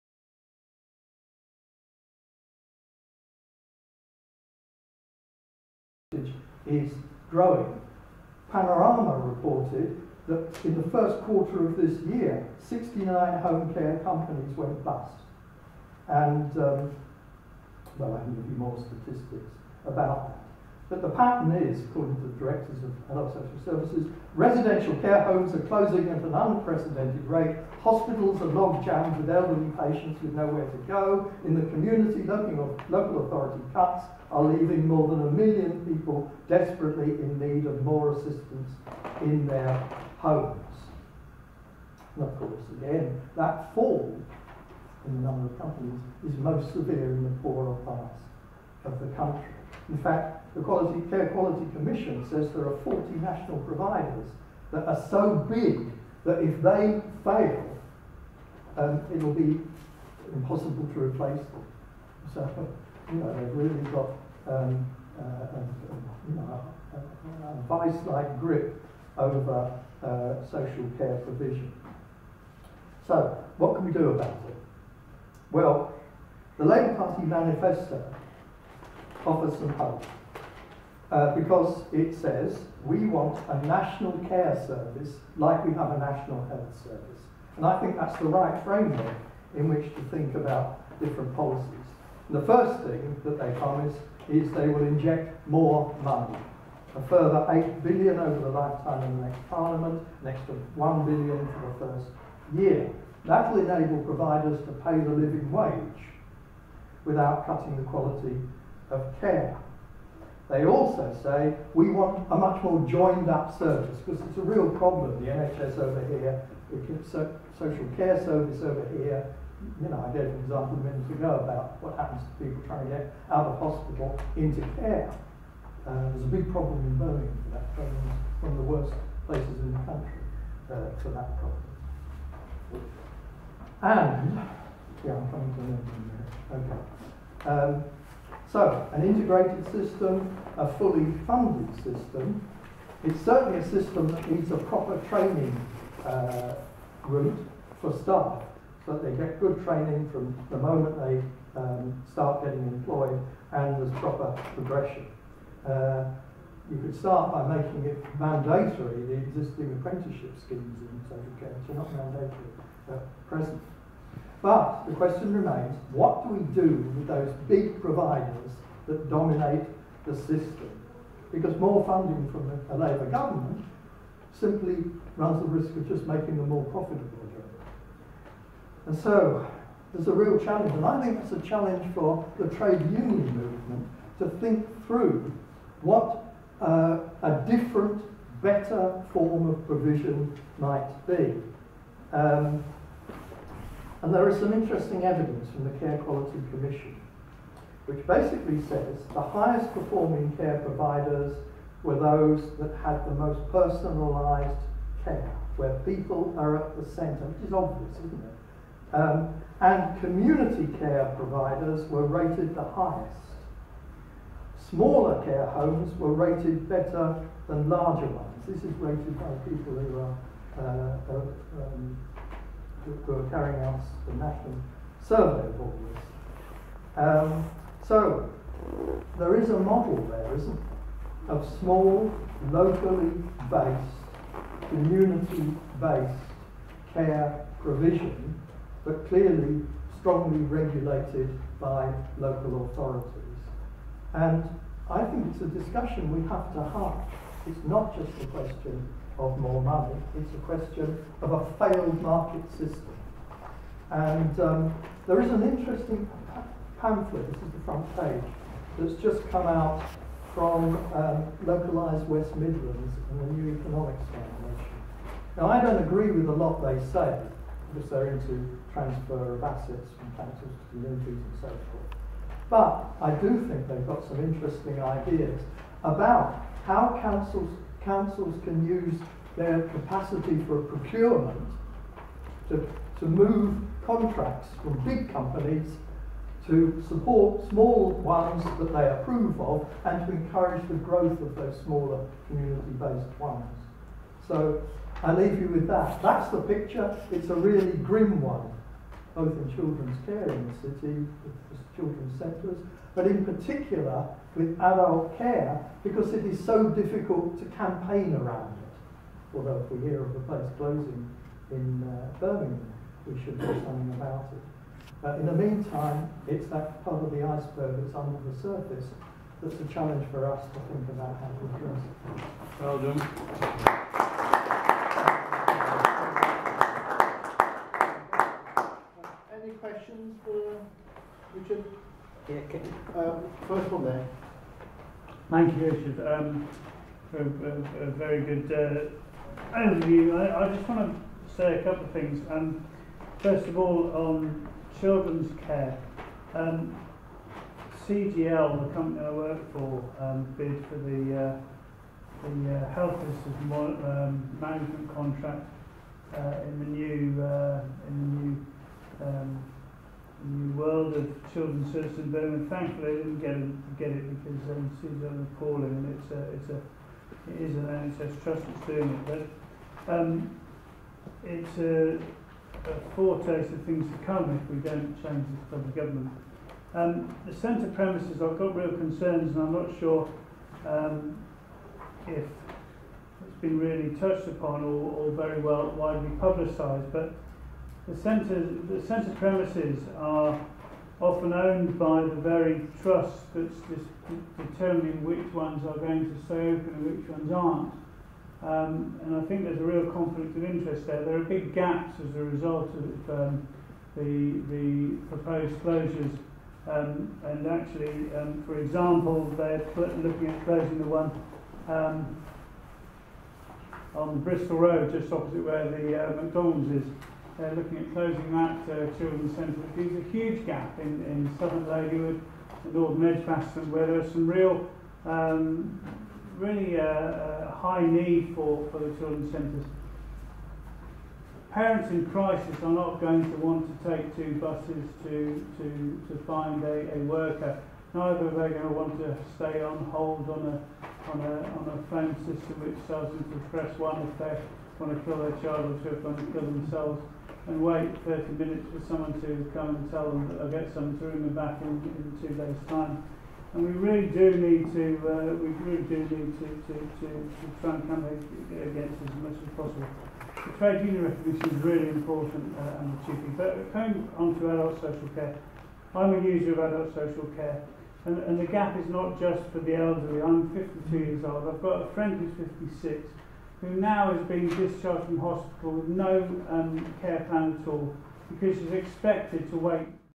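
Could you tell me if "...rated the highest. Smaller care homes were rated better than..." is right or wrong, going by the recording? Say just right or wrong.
right.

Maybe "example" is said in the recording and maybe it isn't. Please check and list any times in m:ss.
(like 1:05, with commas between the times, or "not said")
2:00, 6:48.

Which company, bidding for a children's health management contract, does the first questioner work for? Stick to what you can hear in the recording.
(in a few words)
CGL.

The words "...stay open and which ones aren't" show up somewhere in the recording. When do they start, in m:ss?
6:36.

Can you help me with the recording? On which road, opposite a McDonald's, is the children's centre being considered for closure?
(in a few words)
Bristol Road.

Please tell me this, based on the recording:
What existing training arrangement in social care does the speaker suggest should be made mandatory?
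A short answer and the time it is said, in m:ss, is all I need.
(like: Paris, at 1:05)
apprenticeship schemes, at 2:39.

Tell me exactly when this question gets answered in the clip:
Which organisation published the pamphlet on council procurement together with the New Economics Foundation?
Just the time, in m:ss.
4:21.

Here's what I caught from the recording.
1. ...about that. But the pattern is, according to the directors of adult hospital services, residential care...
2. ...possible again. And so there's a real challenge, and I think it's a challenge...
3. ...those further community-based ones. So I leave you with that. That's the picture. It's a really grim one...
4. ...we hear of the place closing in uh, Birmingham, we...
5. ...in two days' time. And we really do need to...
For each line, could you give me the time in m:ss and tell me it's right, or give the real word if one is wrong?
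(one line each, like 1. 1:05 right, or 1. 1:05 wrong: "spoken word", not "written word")
1. 0:19 wrong: "social", not "hospital"
2. 2:56 wrong: "profitable", not "possible"
3. 4:51 wrong: "smaller", not "further"
4. 5:09 right
5. 7:31 right.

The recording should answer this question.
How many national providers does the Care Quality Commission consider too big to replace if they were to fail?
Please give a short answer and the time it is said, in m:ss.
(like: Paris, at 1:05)
40, at 0:52.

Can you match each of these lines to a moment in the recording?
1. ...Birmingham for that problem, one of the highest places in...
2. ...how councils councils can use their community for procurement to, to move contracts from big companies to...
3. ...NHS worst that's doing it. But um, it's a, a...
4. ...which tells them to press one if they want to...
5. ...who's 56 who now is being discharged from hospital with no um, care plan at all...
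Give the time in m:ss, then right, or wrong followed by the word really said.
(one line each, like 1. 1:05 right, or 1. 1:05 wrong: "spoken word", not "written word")
1. 2:06 wrong: "worst", not "highest"
2. 4:36 wrong: "capacity", not "community"
3. 6:07 wrong: "trust", not "worst"
4. 7:22 right
5. 7:52 right.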